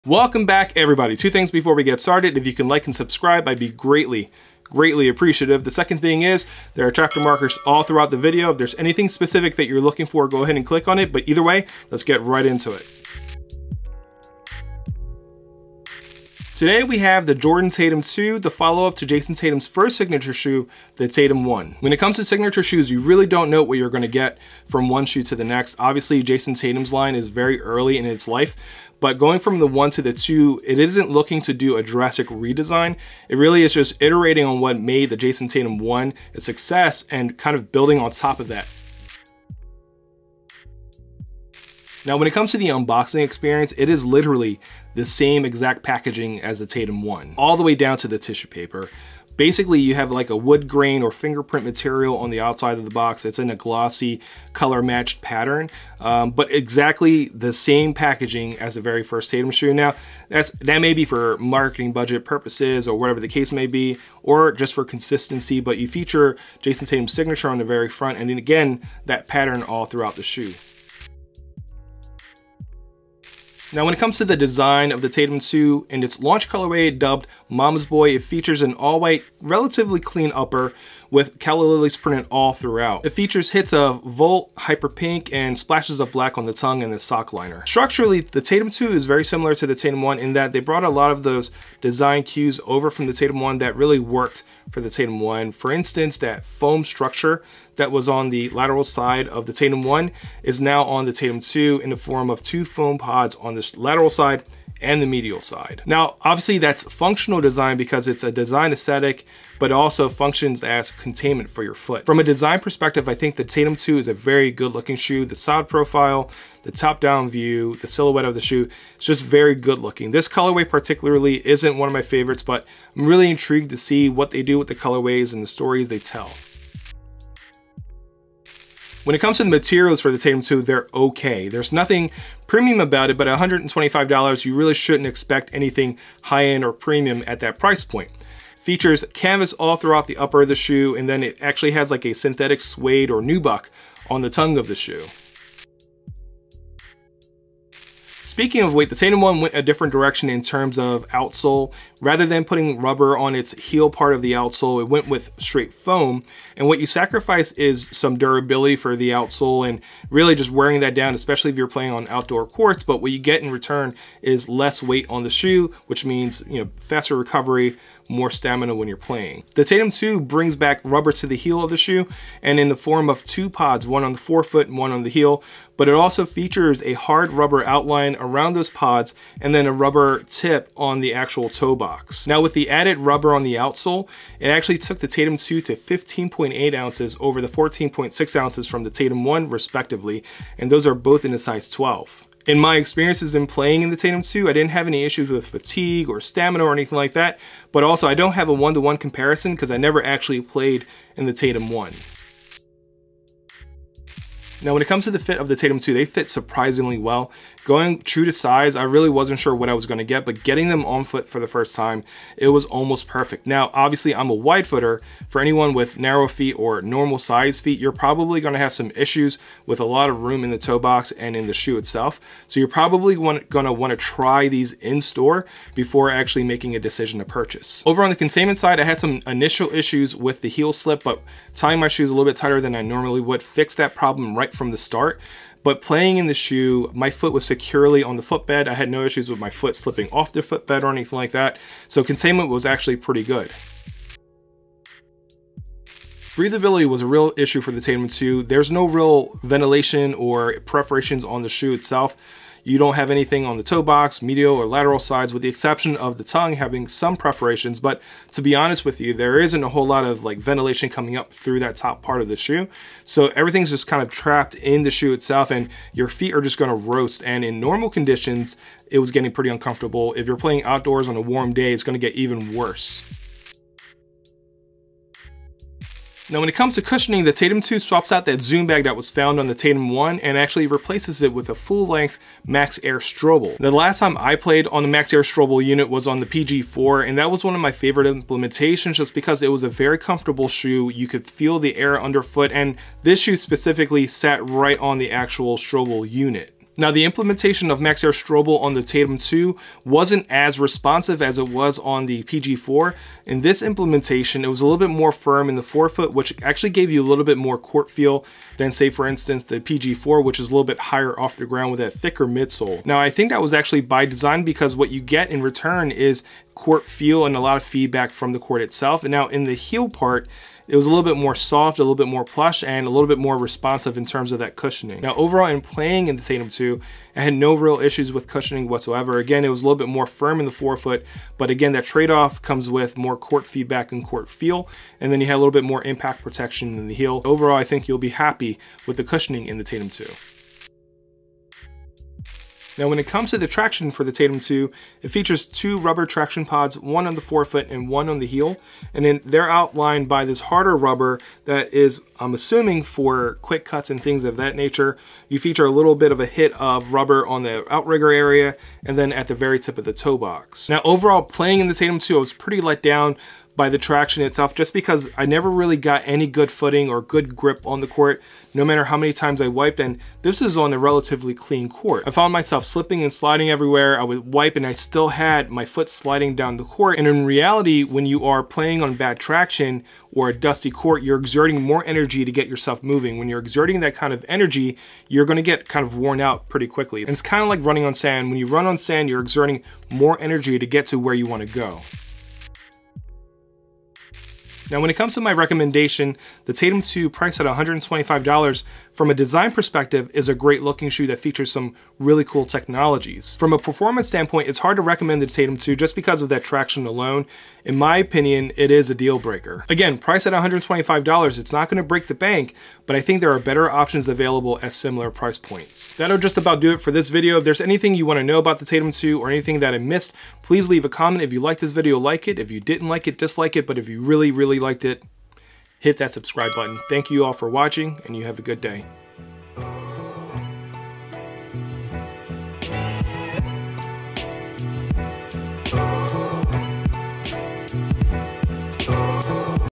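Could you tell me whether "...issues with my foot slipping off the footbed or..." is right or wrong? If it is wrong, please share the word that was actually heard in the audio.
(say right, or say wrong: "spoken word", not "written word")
right.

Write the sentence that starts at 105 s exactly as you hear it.
Now, obviously that's functional design because it's a design aesthetic, but also functions as containment for your foot.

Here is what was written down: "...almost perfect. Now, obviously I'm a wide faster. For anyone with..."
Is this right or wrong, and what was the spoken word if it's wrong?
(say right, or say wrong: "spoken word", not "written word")
wrong: "footer", not "faster".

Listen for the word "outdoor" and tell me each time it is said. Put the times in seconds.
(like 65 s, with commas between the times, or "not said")
162 s, 270 s.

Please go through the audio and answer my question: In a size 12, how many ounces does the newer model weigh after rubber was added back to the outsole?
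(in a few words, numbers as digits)
15.8 ounces.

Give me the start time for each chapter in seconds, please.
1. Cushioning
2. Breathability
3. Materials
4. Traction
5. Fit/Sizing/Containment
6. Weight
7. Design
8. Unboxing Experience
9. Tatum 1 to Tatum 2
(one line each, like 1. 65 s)
1. 275 s
2. 245 s
3. 128 s
4. 341 s
5. 203 s
6. 147 s
7. 73 s
8. 41 s
9. 16 s.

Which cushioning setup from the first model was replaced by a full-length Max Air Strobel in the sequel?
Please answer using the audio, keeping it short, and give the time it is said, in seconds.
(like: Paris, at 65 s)
Zoom bag, at 278 s.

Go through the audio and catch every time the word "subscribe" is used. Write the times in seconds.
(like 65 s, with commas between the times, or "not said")
2 s, 426 s.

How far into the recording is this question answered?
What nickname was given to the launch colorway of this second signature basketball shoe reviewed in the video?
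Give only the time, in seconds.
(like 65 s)
77 s.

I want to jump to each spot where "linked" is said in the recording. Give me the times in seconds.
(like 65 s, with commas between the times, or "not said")
not said.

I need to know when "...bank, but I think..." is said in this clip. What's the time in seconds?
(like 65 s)
412 s.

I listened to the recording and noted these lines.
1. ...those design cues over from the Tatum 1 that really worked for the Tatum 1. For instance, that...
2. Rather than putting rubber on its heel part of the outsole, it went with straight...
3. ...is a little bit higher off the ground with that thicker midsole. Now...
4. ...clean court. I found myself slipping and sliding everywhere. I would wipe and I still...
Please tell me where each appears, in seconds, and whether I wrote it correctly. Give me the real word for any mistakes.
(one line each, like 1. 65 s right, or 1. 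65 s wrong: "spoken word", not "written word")
1. 91 s right
2. 152 s right
3. 310 s right
4. 371 s right.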